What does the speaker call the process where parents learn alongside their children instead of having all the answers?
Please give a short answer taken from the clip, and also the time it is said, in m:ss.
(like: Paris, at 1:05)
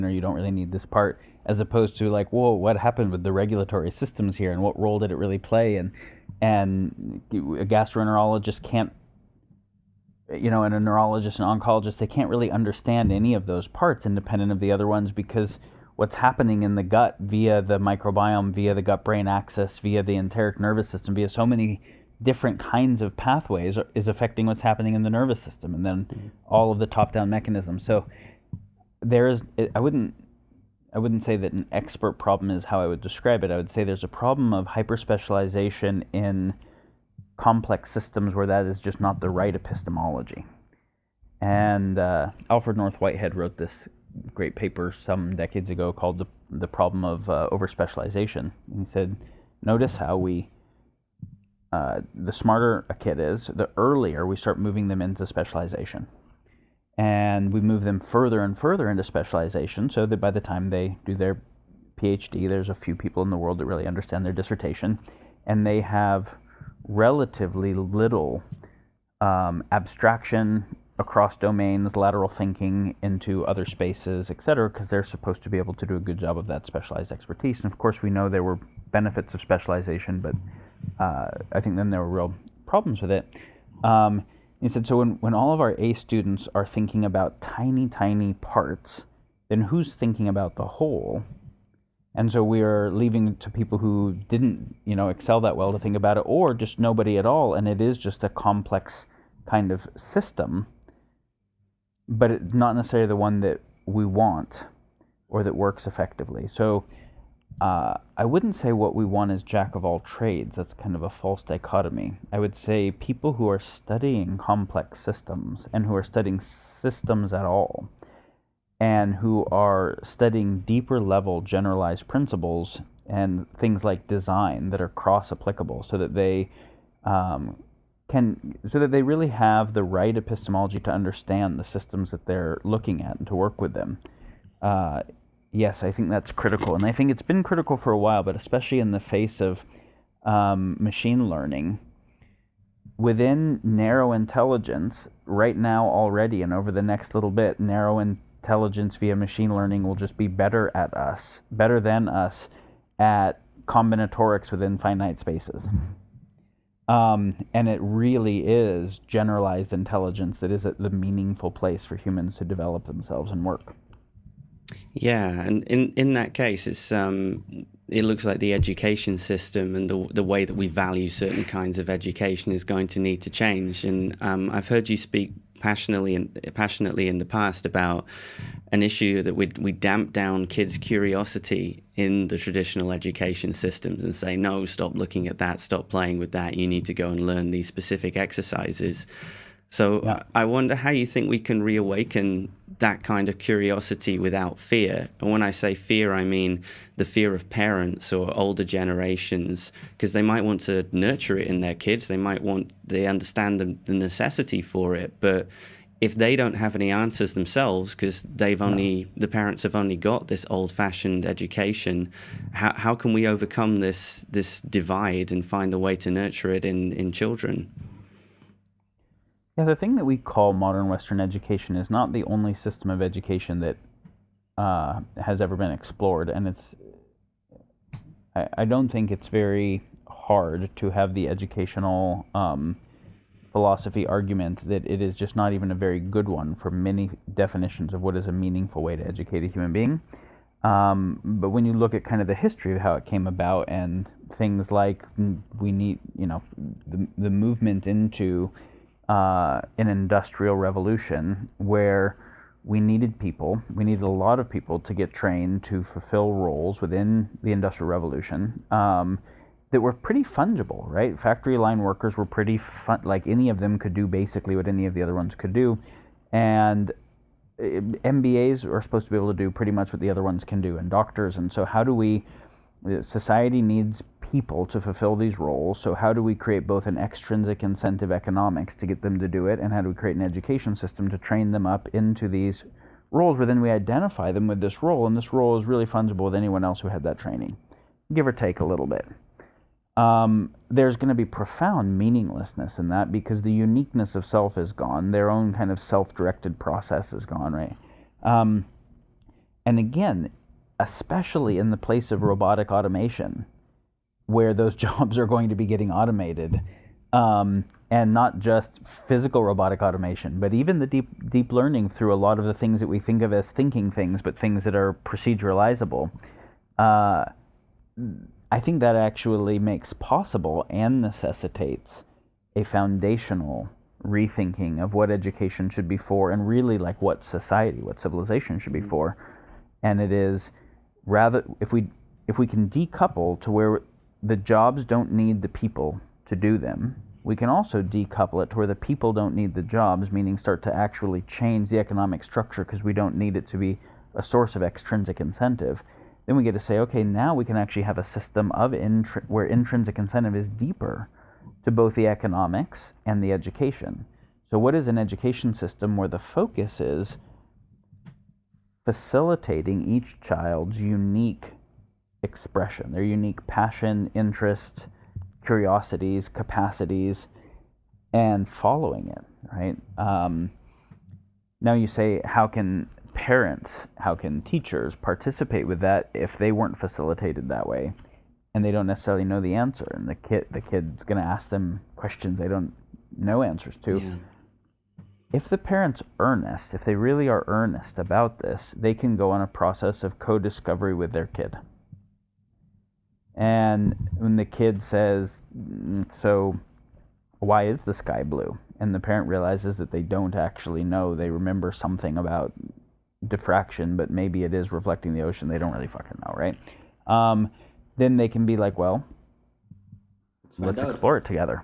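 Co-discovery, at 6:30.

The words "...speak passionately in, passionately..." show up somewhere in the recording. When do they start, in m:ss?
2:54.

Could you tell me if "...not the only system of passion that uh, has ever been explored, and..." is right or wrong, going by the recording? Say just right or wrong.
wrong.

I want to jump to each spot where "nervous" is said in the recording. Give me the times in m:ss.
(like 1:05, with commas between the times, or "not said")
0:20, 0:25.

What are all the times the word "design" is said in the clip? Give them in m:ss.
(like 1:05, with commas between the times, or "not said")
2:04.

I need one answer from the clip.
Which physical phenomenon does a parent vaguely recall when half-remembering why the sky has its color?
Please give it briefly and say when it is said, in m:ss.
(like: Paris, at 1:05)
Diffraction, at 6:43.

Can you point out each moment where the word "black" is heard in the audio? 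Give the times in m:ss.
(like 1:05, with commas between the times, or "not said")
not said.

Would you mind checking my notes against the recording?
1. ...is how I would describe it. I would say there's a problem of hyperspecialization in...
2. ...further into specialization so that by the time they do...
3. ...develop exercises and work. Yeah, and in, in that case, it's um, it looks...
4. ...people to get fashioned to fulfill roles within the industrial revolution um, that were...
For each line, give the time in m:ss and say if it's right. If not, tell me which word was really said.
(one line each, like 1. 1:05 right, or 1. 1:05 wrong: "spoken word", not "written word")
1. 0:32 right
2. 0:58 right
3. 2:42 wrong: "themselves", not "exercises"
4. 4:14 wrong: "trained", not "fashioned".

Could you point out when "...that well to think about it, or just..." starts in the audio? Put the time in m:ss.
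1:35.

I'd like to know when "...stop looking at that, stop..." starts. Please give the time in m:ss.
3:04.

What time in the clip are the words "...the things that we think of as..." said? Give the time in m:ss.
5:12.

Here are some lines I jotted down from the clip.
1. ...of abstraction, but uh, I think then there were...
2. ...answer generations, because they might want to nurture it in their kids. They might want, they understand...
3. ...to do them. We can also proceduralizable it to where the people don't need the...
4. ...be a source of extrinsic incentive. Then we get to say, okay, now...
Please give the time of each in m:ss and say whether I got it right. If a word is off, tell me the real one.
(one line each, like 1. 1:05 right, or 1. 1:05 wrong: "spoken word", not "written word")
1. 1:19 wrong: "specialization", not "abstraction"
2. 3:18 wrong: "older", not "answer"
3. 5:36 wrong: "decouple", not "proceduralizable"
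4. 5:43 right.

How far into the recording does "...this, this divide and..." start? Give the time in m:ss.
3:33.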